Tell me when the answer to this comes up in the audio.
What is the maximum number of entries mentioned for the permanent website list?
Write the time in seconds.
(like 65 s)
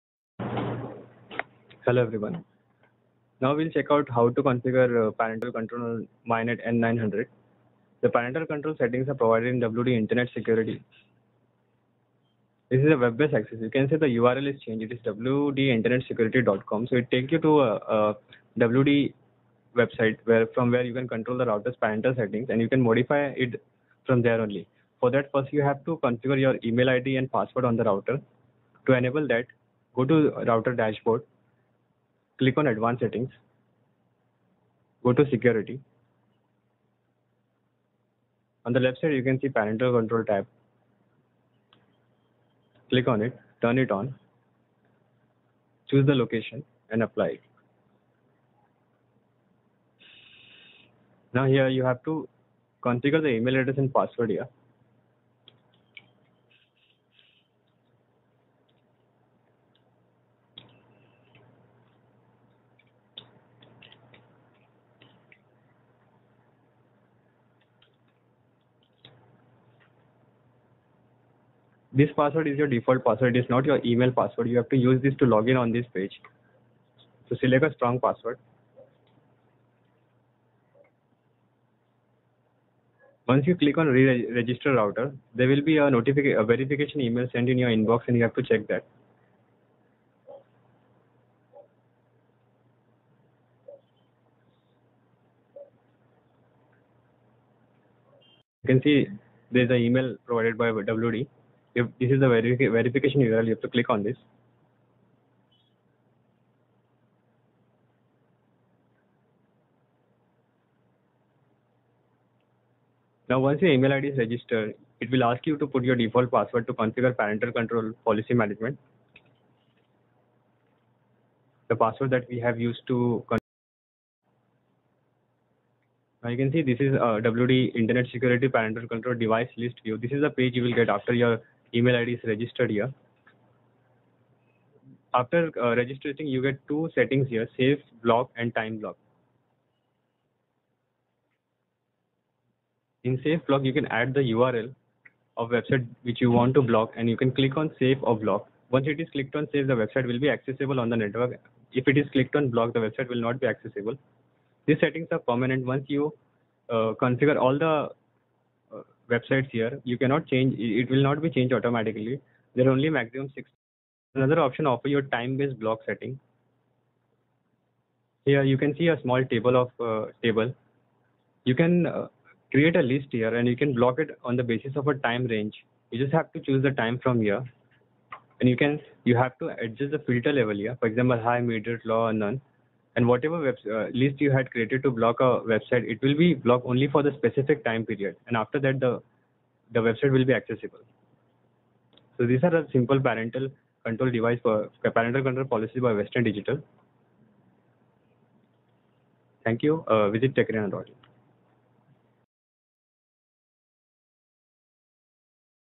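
163 s.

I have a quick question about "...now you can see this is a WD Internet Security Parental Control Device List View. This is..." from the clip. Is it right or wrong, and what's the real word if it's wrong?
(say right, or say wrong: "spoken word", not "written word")
right.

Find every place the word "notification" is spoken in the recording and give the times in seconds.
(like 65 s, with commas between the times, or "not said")
85 s.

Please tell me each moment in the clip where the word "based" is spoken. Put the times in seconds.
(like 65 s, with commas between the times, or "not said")
12 s, 165 s.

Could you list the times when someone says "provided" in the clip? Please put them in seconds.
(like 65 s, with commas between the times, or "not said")
9 s, 100 s.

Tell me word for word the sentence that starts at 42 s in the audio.
Click on it, turn it on, choose the location and apply it.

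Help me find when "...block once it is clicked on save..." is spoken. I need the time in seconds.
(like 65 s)
148 s.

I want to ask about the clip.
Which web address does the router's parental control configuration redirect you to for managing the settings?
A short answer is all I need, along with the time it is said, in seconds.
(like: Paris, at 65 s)
wdinternetsecurity.com, at 15 s.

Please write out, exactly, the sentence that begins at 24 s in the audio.
For that, first you have to configure your email ID and password on the router.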